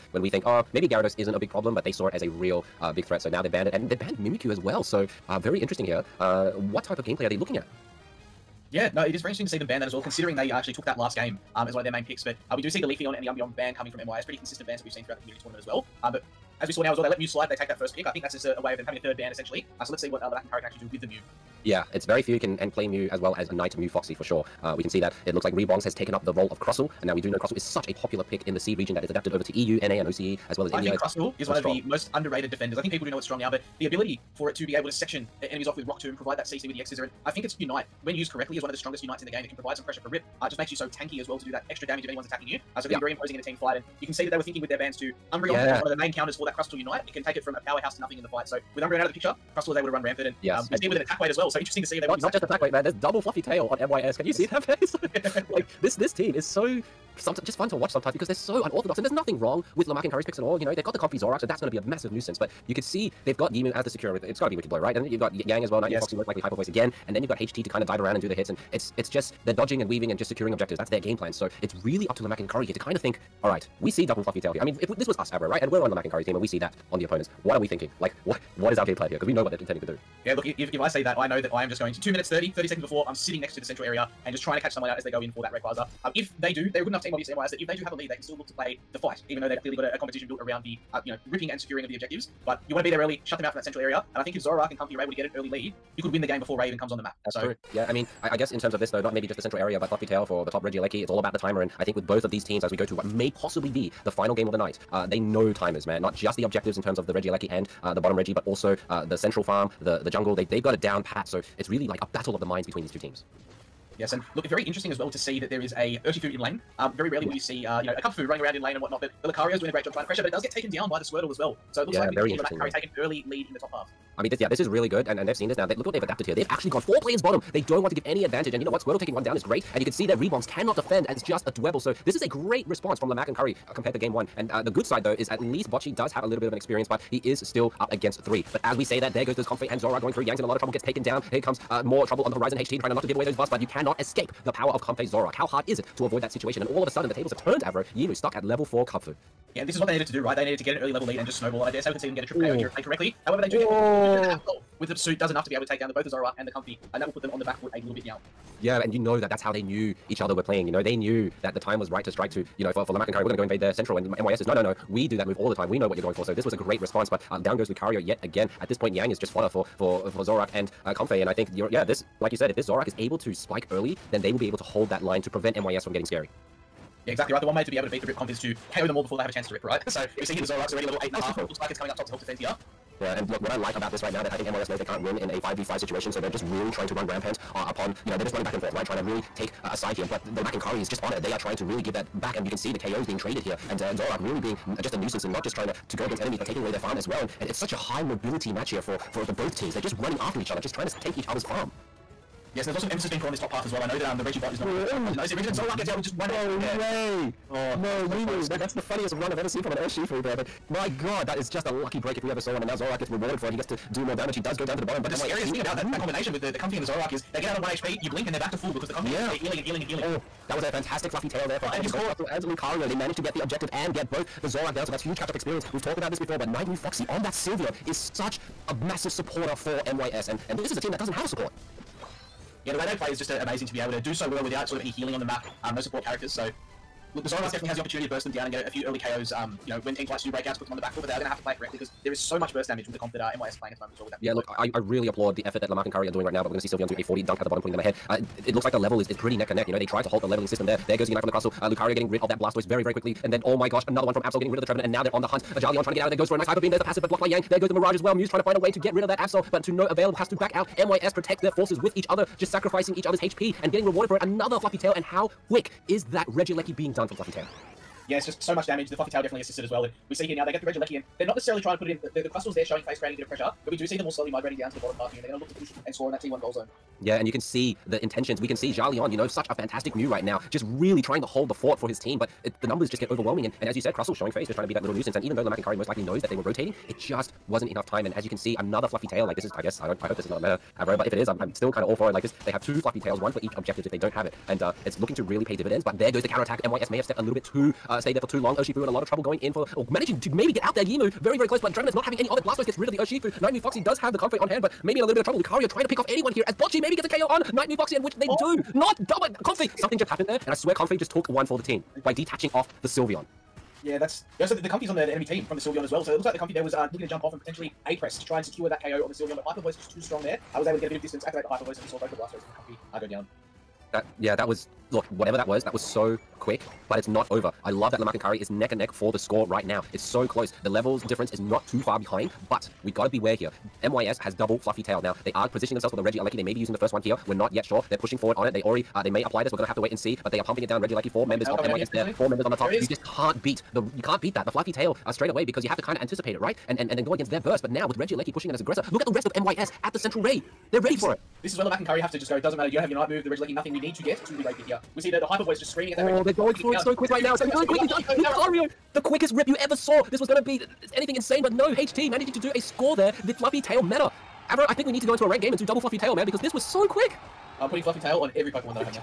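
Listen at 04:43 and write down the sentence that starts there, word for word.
And, and as you said, Crustle showing face, just trying to be that little nuisance.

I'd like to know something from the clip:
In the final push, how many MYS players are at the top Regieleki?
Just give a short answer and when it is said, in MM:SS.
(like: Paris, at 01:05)
4, at 05:42.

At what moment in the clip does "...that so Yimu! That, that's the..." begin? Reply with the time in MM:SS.
03:28.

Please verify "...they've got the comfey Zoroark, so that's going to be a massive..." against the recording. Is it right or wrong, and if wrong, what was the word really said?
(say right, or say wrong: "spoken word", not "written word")
right.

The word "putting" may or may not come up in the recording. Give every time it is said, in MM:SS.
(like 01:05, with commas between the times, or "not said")
04:07, 06:07.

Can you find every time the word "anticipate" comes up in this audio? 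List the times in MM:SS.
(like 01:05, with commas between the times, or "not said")
05:46.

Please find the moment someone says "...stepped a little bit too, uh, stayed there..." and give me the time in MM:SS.
04:57.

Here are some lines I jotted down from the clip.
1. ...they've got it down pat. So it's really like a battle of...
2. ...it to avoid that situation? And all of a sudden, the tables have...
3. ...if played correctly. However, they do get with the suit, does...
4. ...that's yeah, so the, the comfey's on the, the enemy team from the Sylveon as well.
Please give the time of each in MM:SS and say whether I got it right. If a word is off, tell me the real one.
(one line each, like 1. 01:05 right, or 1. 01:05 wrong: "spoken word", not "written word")
1. 01:50 right
2. 02:25 right
3. 02:32 right
4. 05:13 right.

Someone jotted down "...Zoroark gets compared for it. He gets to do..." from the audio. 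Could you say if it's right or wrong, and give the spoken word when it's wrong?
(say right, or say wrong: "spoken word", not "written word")
wrong: "rewarded", not "compared".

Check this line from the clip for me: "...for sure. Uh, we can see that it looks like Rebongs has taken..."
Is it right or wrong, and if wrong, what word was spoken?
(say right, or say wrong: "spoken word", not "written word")
right.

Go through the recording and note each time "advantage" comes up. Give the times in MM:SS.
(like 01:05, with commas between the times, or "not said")
02:08.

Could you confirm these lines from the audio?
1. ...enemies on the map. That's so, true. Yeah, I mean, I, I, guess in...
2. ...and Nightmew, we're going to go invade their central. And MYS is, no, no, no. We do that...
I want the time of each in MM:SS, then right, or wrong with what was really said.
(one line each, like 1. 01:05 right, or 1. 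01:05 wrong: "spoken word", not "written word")
1. 01:36 wrong: "comes", not "enemies"
2. 02:43 wrong: "Curry", not "Nightmew".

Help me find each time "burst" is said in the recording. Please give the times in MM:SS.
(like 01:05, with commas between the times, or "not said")
03:58, 04:02, 05:47.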